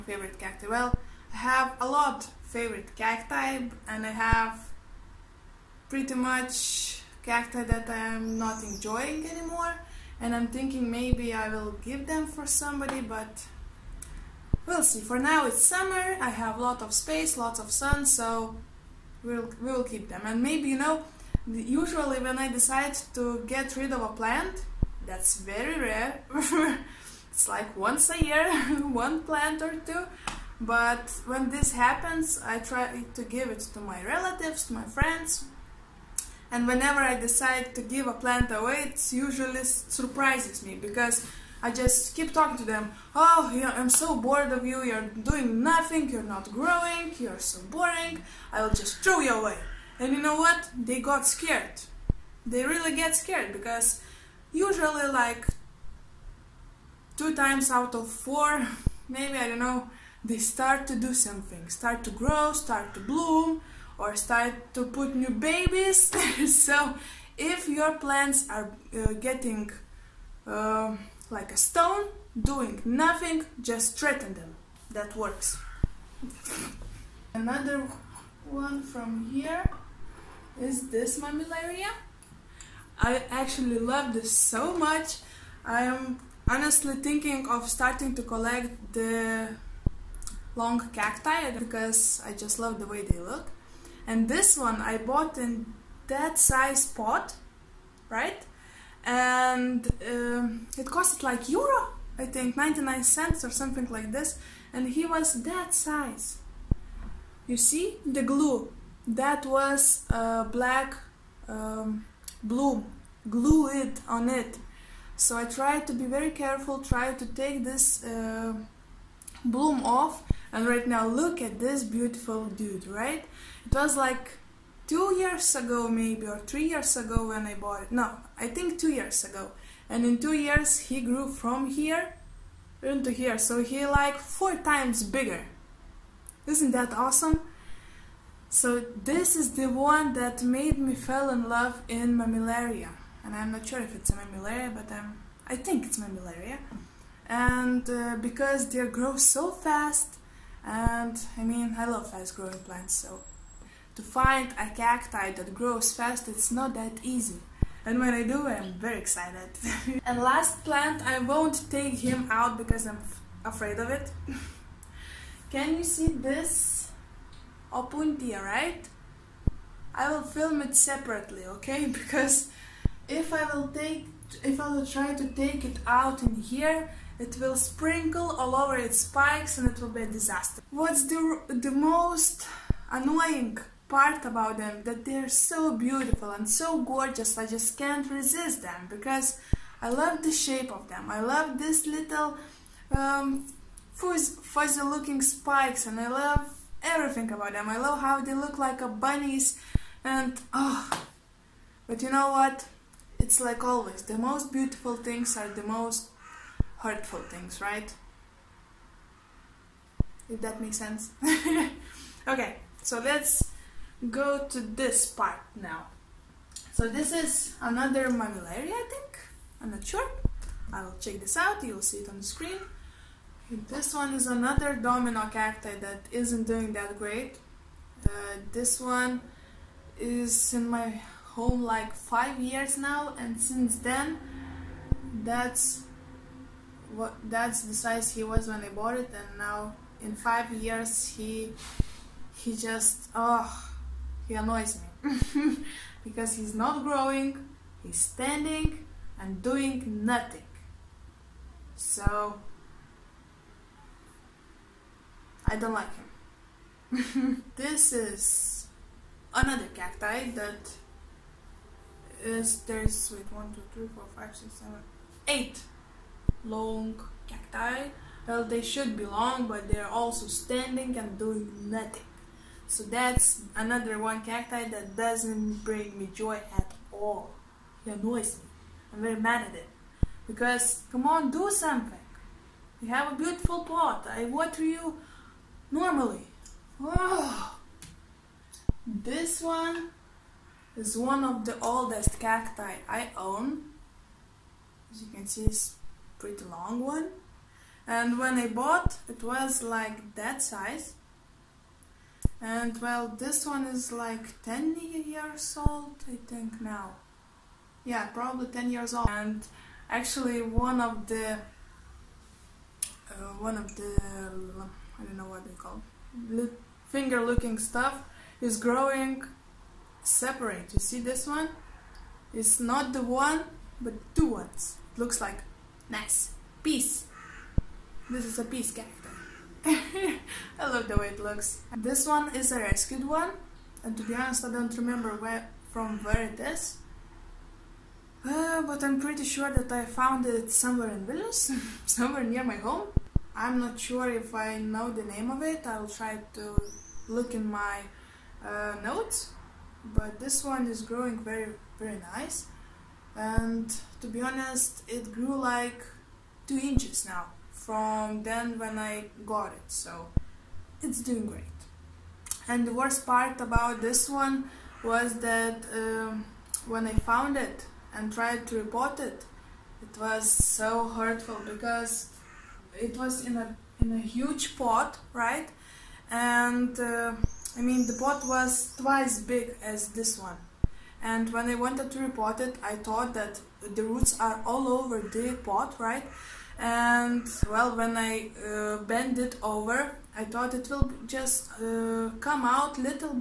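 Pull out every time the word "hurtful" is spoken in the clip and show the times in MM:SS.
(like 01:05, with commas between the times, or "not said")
03:26, 06:10.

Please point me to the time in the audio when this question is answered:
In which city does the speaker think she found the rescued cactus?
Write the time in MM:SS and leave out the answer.
05:41.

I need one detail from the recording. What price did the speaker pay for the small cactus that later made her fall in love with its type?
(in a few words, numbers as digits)
99 cents.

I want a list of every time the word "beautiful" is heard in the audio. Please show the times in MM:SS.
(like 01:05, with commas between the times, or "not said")
02:01, 03:05, 03:24, 04:43.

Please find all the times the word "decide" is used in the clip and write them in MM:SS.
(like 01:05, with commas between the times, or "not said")
00:22, 00:37.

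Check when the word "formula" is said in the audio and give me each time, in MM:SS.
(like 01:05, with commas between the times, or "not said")
not said.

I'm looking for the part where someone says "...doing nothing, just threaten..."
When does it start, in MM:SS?
01:12.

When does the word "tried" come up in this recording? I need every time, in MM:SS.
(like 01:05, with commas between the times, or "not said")
01:55, 06:08.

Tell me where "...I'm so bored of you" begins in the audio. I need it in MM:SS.
00:43.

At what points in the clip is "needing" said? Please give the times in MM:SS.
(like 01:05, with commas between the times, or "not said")
not said.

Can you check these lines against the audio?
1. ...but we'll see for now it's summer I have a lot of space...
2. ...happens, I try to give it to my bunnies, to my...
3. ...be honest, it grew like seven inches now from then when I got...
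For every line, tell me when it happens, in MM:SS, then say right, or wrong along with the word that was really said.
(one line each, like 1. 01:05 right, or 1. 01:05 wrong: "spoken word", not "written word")
1. 00:13 right
2. 00:31 wrong: "relatives", not "bunnies"
3. 05:54 wrong: "two", not "seven".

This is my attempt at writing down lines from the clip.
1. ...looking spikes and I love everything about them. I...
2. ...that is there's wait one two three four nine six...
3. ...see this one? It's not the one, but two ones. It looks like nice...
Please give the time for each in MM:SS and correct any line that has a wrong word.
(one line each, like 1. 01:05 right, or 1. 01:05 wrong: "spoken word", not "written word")
1. 03:14 right
2. 04:20 wrong: "five", not "nine"
3. 05:20 right.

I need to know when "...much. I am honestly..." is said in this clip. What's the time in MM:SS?
01:24.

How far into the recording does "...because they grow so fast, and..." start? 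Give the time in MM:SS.
02:28.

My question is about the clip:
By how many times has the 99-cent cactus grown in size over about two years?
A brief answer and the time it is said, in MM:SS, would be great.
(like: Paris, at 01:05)
4 times, at 02:14.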